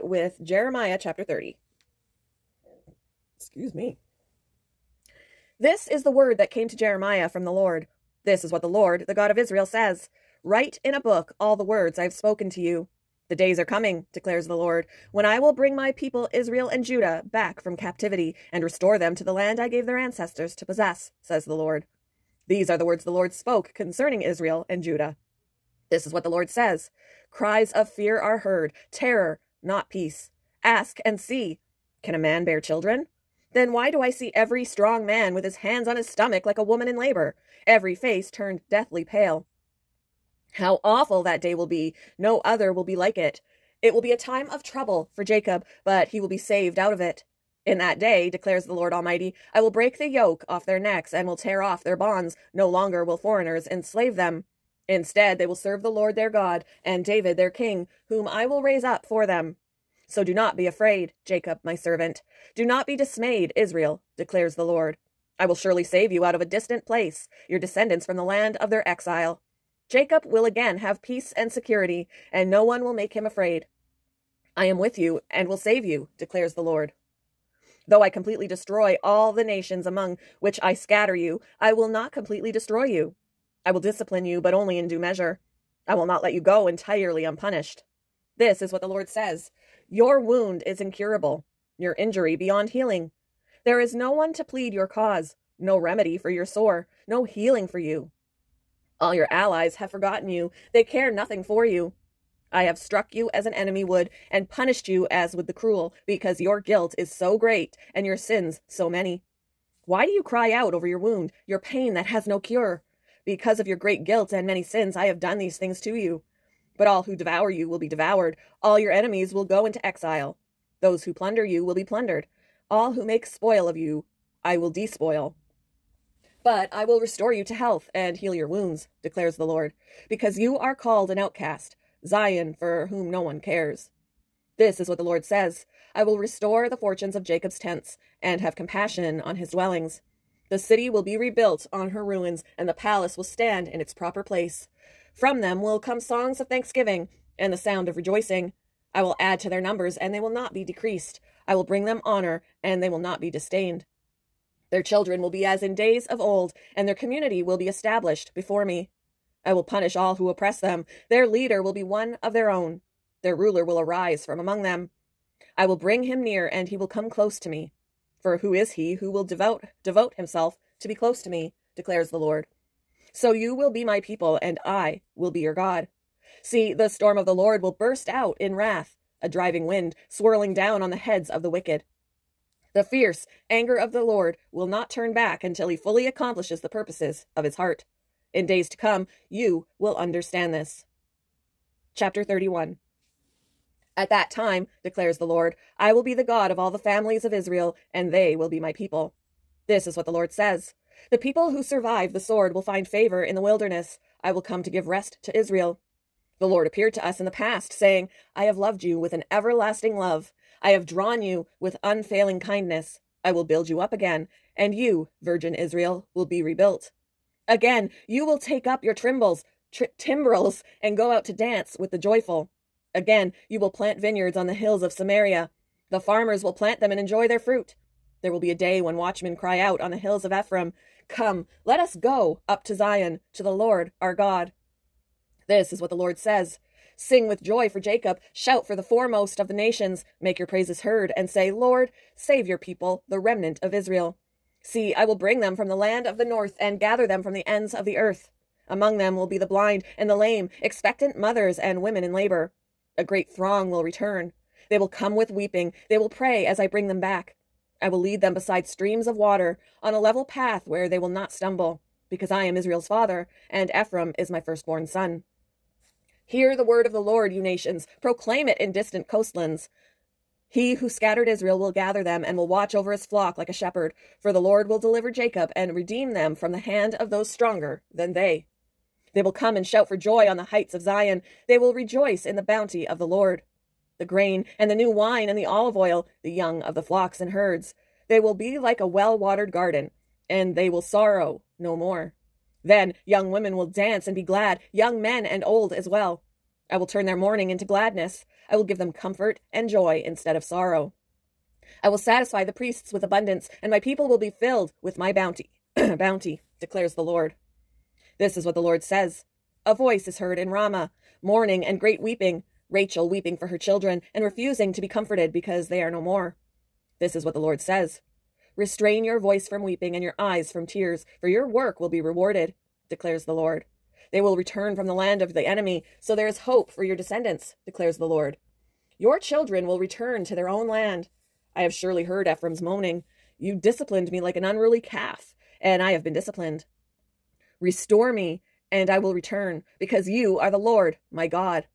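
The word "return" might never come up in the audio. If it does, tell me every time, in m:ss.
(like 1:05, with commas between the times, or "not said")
4:13, 5:24, 5:29, 5:39.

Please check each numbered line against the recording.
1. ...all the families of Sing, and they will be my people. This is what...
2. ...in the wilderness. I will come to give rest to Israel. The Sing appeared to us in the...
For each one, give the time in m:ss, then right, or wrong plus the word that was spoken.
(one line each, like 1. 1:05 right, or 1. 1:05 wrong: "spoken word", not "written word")
1. 3:16 wrong: "Israel", not "Sing"
2. 3:23 wrong: "Lord", not "Sing".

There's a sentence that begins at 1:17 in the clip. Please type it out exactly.
Though I completely destroy all the nations among which I scatter you, I will not completely destroy you.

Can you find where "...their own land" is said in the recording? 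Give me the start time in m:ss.
5:30.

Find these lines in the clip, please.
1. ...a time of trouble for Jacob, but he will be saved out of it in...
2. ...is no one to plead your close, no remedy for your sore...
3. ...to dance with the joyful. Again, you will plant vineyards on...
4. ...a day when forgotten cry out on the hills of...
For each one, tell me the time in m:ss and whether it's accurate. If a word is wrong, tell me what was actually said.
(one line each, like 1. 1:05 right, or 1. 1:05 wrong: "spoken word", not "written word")
1. 0:44 right
2. 1:33 wrong: "cause", not "close"
3. 3:41 right
4. 3:48 wrong: "watchmen", not "forgotten".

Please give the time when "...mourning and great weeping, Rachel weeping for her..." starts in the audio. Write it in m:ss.
5:11.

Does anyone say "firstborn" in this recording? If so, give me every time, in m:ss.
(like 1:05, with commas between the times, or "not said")
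4:24.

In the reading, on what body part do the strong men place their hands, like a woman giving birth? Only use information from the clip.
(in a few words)
stomach.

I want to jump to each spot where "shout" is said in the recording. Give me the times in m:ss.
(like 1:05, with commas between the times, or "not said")
3:58, 4:39.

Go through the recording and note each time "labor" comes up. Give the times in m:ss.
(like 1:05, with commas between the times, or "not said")
0:36, 4:12.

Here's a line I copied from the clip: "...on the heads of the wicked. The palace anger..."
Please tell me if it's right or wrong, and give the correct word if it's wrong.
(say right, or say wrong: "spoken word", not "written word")
wrong: "fierce", not "palace".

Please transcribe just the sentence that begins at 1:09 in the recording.
Jacob will again have peace and security, and no one will make him afraid.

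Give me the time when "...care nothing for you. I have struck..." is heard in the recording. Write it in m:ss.
1:40.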